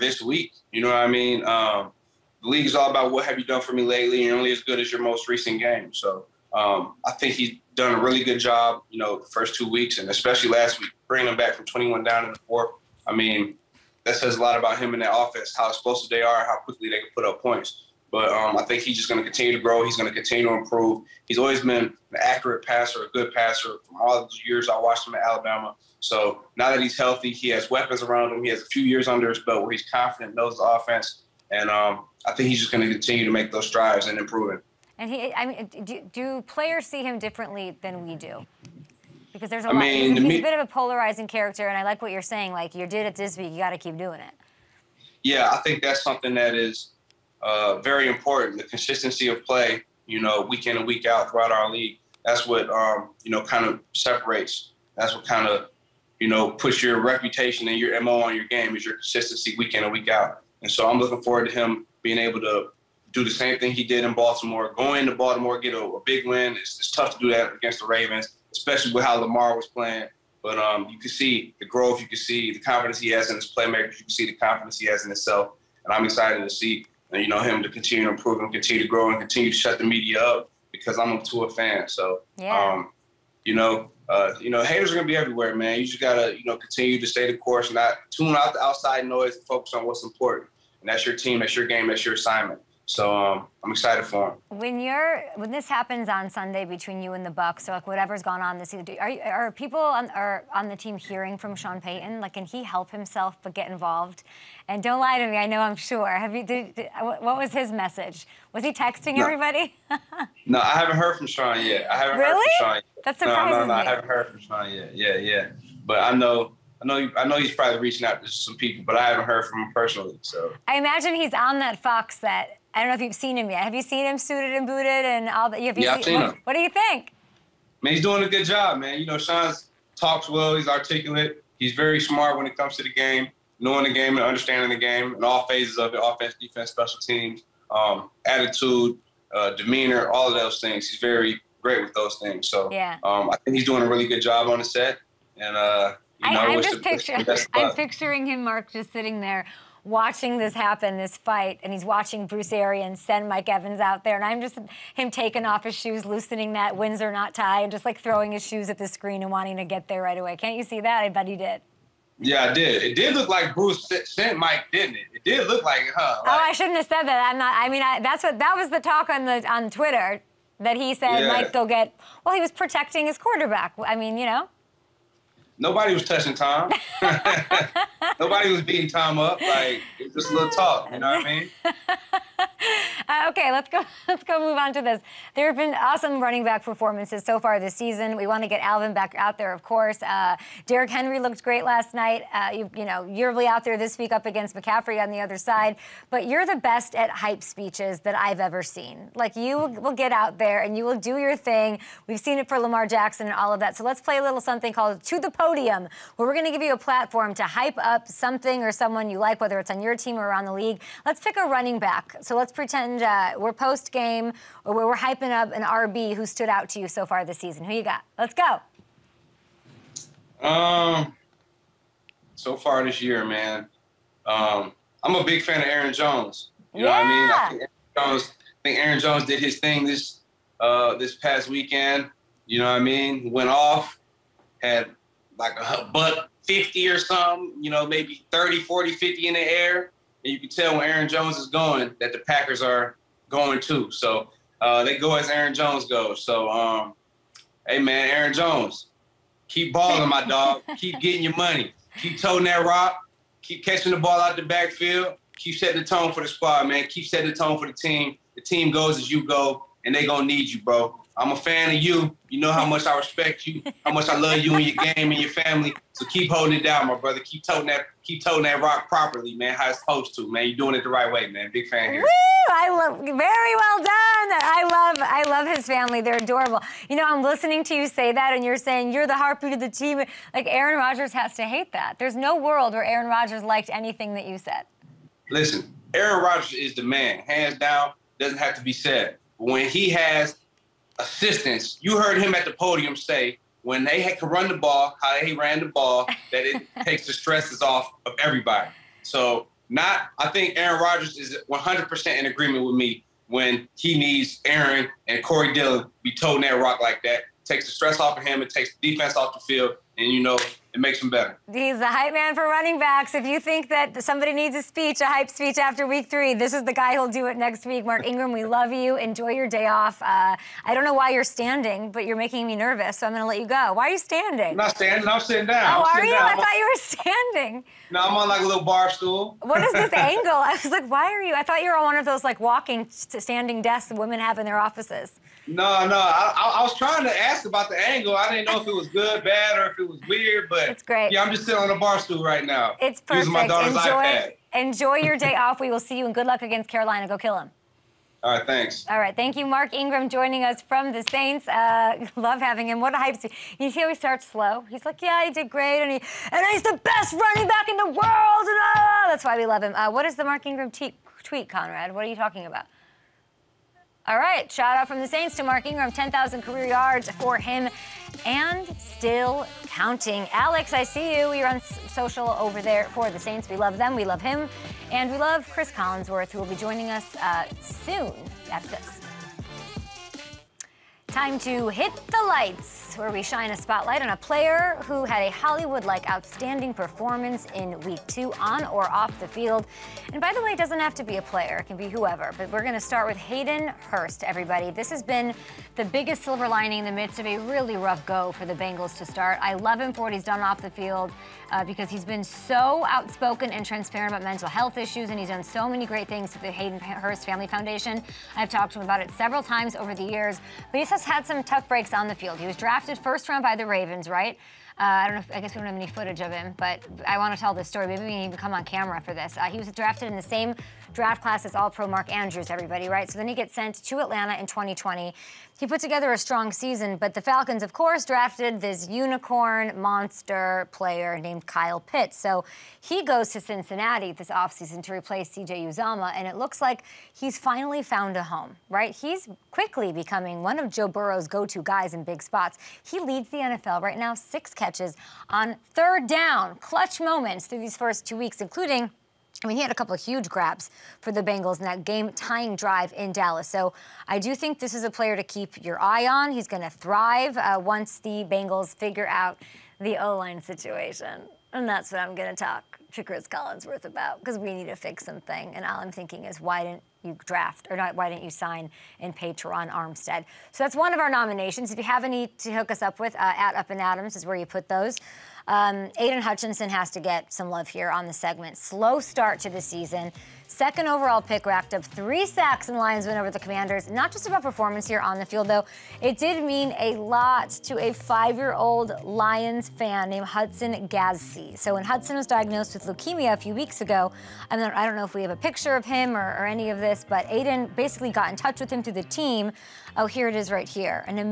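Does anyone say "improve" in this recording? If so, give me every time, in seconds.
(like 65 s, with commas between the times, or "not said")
20 s, 34 s, 78 s.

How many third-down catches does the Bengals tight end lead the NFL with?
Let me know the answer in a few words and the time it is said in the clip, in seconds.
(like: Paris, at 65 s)
6, at 444 s.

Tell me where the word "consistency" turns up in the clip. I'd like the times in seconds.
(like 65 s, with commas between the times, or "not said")
48 s, 58 s.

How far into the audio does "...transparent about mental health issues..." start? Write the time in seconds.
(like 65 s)
403 s.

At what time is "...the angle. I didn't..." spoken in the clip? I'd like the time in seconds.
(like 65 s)
337 s.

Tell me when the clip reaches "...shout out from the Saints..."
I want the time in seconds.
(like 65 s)
364 s.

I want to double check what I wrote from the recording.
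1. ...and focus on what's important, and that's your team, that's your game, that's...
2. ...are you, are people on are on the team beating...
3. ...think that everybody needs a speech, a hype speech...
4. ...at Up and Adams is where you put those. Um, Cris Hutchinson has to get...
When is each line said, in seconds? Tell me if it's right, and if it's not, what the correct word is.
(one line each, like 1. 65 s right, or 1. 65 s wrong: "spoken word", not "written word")
1. 89 s right
2. 98 s wrong: "hearing", not "beating"
3. 313 s wrong: "somebody", not "everybody"
4. 473 s wrong: "Aidan", not "Cris".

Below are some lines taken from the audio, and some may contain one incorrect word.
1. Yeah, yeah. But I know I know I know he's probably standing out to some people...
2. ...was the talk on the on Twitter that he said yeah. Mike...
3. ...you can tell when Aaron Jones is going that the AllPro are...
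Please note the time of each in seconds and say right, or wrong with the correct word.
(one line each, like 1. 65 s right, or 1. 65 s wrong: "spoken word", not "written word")
1. 114 s wrong: "reaching", not "standing"
2. 168 s right
3. 240 s wrong: "Packers", not "AllPro".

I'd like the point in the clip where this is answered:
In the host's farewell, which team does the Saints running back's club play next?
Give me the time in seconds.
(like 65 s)
346 s.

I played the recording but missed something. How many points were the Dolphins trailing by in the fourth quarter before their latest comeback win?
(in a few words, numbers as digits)
21.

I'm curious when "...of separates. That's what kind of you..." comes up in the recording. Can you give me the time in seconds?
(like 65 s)
53 s.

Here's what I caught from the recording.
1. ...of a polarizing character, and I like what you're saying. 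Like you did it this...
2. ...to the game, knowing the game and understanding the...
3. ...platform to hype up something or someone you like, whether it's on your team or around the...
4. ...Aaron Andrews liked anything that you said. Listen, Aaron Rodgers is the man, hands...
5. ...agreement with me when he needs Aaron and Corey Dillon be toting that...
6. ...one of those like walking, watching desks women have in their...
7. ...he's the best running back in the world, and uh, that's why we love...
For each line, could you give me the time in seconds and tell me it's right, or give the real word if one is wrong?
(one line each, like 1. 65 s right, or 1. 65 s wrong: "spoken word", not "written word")
1. 40 s right
2. 132 s right
3. 206 s right
4. 282 s wrong: "Rodgers", not "Andrews"
5. 302 s right
6. 331 s wrong: "standing", not "watching"
7. 356 s right.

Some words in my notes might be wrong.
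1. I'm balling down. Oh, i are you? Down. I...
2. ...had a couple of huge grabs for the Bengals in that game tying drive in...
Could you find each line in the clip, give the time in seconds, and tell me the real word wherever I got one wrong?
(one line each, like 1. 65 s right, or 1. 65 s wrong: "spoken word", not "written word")
1. 325 s wrong: "sitting", not "balling"
2. 449 s right.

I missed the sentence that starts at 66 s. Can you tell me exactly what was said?
It's, it's, tough to do that against the Ravens, especially with how Lamar was playing.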